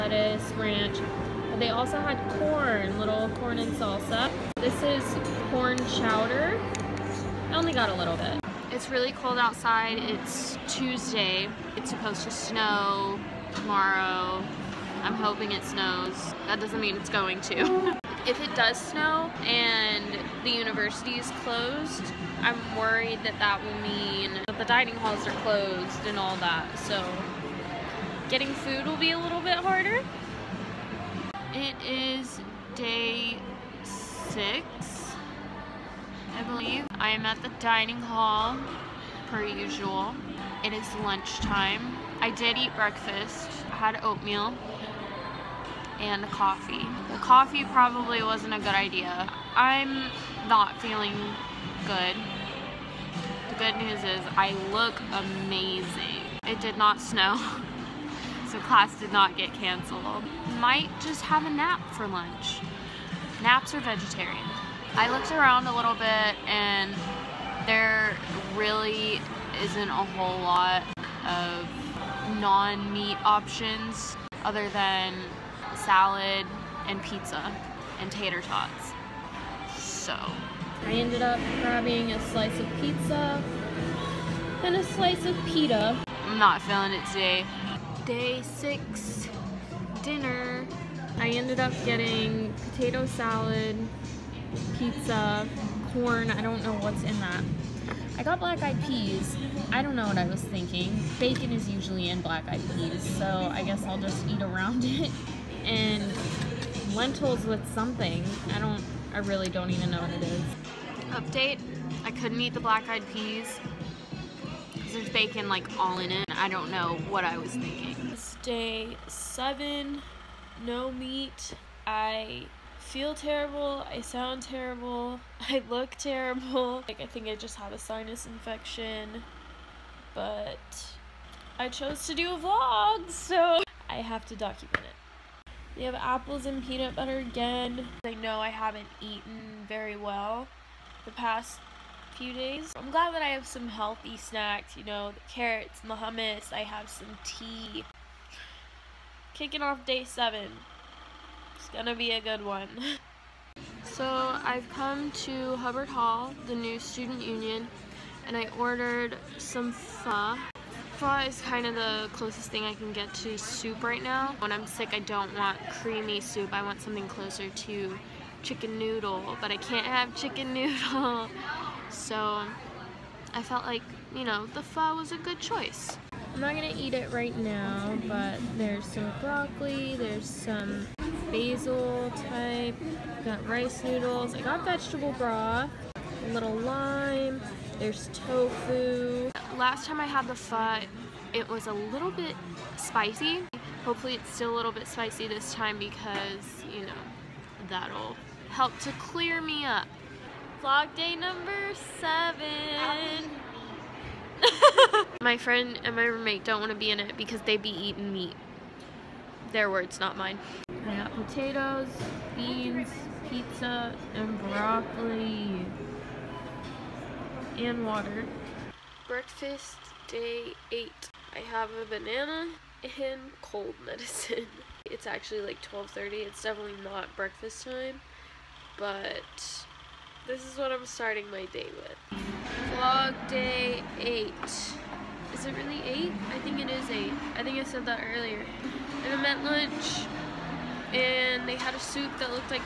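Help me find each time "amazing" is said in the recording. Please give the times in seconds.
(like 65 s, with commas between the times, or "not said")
55 s.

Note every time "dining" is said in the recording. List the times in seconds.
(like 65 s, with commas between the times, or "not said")
24 s, 37 s.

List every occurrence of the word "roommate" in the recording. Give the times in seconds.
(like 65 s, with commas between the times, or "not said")
206 s.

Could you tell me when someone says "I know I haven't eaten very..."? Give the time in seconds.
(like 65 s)
138 s.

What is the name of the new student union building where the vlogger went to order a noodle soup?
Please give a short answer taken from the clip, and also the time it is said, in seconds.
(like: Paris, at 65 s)
Hubbard Hall, at 155 s.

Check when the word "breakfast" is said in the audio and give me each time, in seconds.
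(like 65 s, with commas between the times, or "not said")
42 s, 219 s, 227 s.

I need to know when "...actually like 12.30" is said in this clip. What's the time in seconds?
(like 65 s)
225 s.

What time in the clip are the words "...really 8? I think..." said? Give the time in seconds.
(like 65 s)
235 s.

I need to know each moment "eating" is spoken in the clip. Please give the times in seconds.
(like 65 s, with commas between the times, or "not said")
207 s.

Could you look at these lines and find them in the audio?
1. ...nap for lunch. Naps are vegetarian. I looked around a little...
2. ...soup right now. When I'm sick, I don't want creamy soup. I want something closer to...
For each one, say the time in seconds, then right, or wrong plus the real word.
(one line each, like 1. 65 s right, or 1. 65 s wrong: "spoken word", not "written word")
1. 61 s right
2. 163 s right.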